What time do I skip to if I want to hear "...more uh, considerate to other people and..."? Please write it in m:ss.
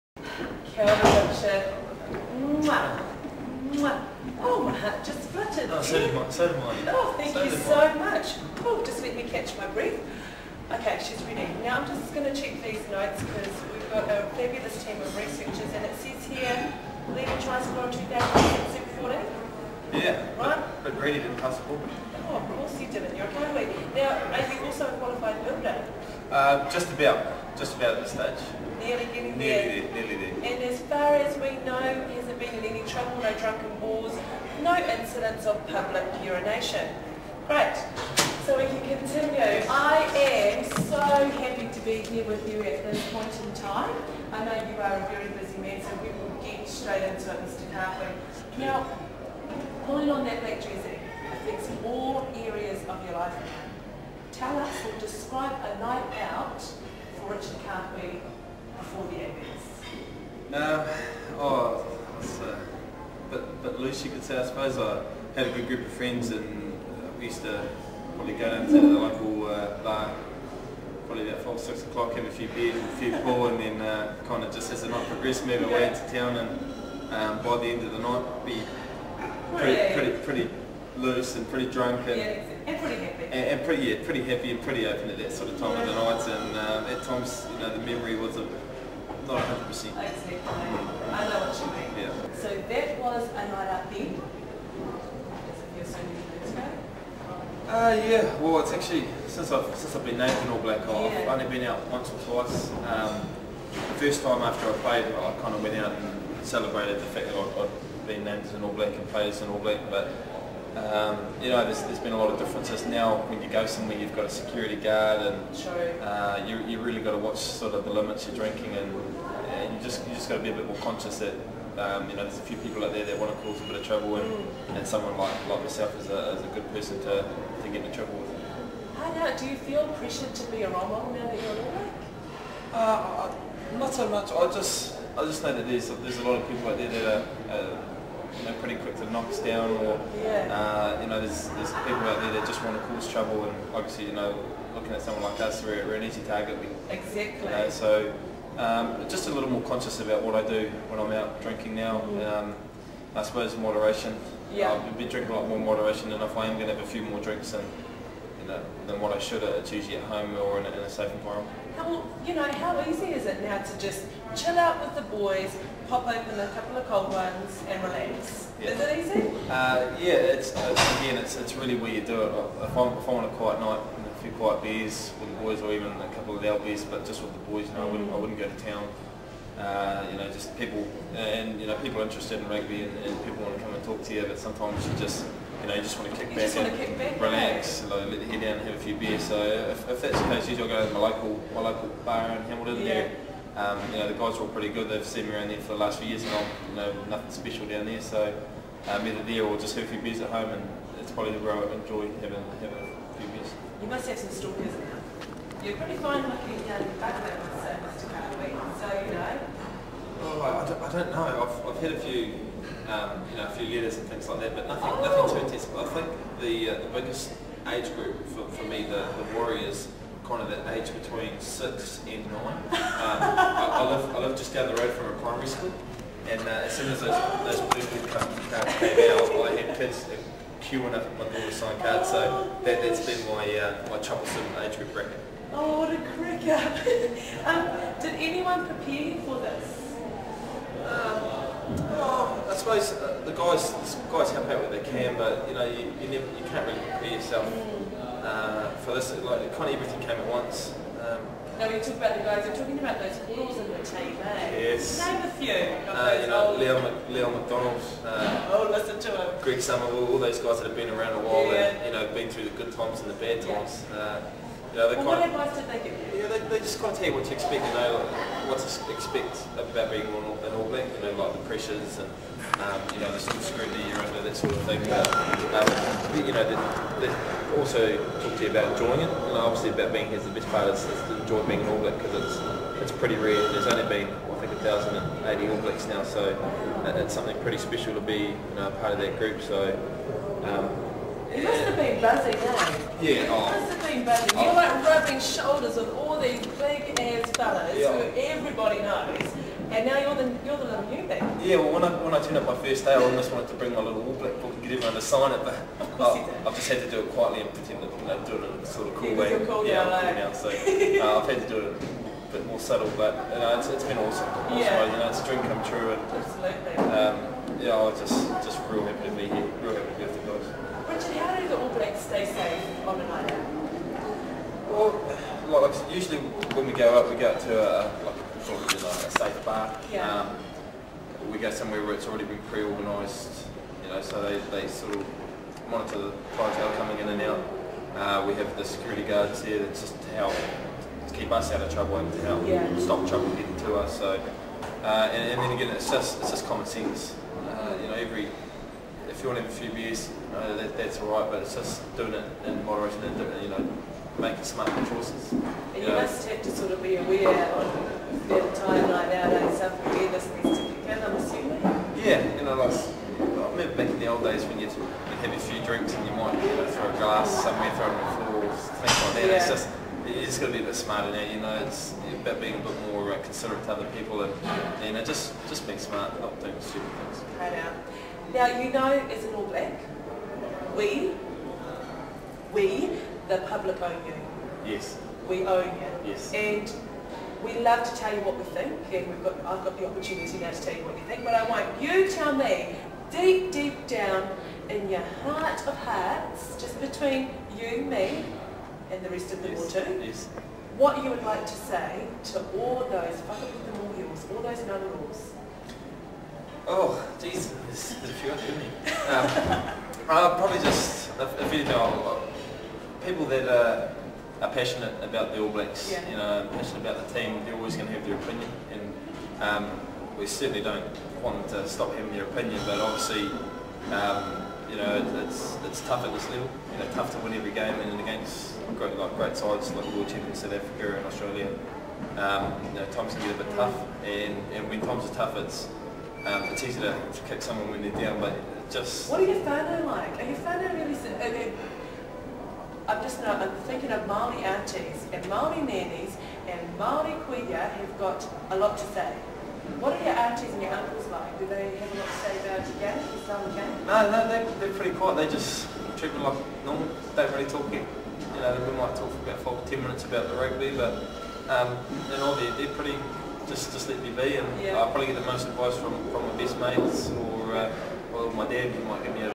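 6:12.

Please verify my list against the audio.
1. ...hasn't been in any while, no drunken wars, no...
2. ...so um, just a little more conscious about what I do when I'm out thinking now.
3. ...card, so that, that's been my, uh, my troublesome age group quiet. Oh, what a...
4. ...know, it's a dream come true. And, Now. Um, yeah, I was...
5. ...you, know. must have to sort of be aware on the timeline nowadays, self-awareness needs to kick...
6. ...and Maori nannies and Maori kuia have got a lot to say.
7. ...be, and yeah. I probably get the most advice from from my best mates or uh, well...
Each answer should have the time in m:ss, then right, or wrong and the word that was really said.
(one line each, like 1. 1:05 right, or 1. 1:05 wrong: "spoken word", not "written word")
1. 0:32 wrong: "trouble", not "while"
2. 2:27 wrong: "drinking", not "thinking"
3. 3:51 wrong: "bracket", not "quiet"
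4. 5:15 wrong: "Absolutely", not "Now"
5. 5:55 right
6. 7:25 right
7. 7:44 right.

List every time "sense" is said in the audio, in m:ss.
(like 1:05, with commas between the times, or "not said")
5:46.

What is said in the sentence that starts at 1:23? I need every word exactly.
And, and, pretty, yeah, pretty happy and pretty open at that sort of time yeah.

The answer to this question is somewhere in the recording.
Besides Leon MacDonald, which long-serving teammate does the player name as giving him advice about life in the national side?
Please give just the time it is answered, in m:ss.
4:19.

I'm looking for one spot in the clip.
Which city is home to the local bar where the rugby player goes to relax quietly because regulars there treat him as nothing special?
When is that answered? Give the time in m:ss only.
3:12.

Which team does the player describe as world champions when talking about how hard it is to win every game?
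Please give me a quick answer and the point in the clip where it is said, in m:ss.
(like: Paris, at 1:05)
South Africa, at 7:10.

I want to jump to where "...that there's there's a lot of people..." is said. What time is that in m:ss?
2:15.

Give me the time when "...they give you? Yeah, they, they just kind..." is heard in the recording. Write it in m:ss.
4:25.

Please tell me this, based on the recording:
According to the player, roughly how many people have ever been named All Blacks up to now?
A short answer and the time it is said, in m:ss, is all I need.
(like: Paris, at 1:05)
1,080, at 4:44.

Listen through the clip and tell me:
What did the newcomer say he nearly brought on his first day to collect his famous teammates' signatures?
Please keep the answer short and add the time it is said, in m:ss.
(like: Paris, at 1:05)
All Black book, at 5:03.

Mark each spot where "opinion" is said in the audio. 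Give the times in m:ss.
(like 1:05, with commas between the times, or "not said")
6:58, 7:02.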